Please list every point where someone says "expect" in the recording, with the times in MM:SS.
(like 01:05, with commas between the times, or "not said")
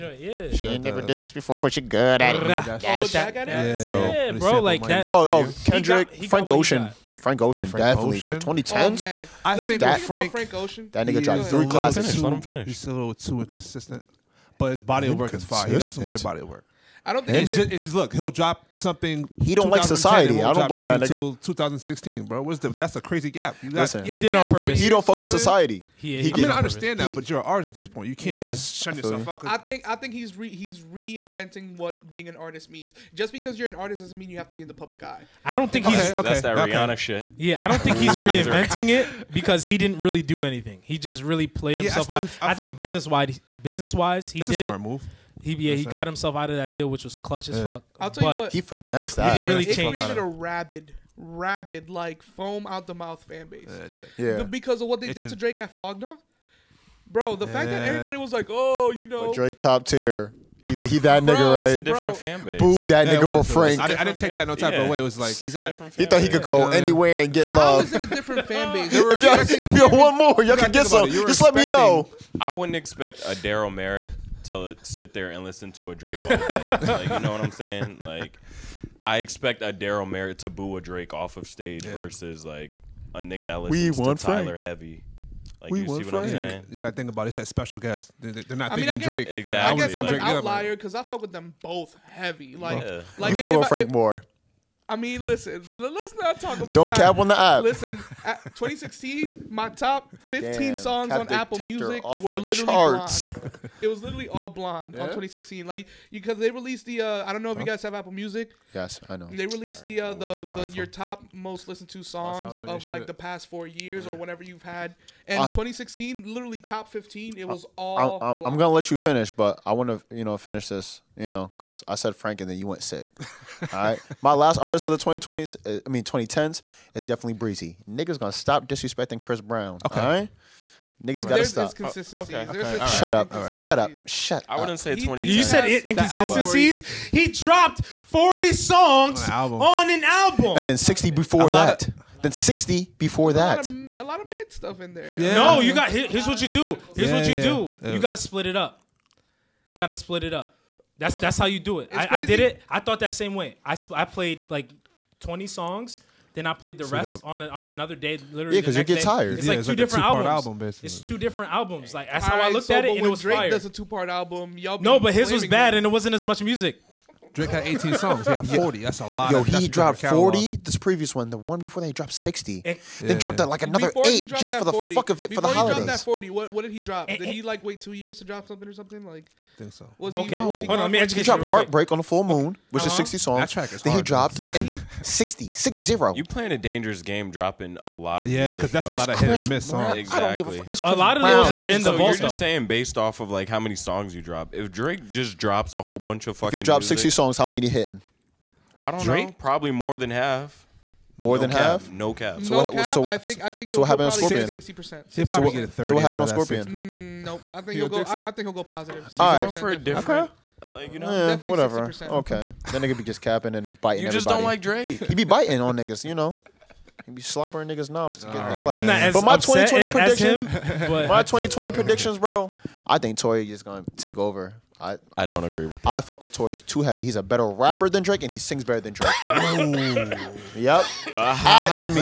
01:12, 01:19.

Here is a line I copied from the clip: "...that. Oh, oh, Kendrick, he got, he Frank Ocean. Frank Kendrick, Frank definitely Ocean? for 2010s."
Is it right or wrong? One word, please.
wrong.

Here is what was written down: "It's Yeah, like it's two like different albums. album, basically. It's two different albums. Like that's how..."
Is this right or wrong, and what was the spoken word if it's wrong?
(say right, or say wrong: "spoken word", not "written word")
right.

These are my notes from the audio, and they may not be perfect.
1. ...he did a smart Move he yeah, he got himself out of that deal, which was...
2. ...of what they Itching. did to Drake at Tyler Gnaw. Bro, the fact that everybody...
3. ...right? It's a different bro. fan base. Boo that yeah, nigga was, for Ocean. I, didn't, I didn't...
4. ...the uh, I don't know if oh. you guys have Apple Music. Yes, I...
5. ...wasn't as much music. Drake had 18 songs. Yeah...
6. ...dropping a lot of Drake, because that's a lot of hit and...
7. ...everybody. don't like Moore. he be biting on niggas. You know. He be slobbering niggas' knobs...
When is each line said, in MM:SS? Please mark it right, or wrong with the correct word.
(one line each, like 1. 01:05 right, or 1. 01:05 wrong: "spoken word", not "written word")
1. 00:44 right
2. 00:54 wrong: "Flog", not "Tyler"
3. 01:01 wrong: "Frank", not "Ocean"
4. 01:46 right
5. 02:45 right
6. 03:07 wrong: "Yeah", not "Drake"
7. 03:34 wrong: "Drake", not "Moore".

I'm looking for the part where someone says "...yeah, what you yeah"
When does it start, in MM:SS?
02:27.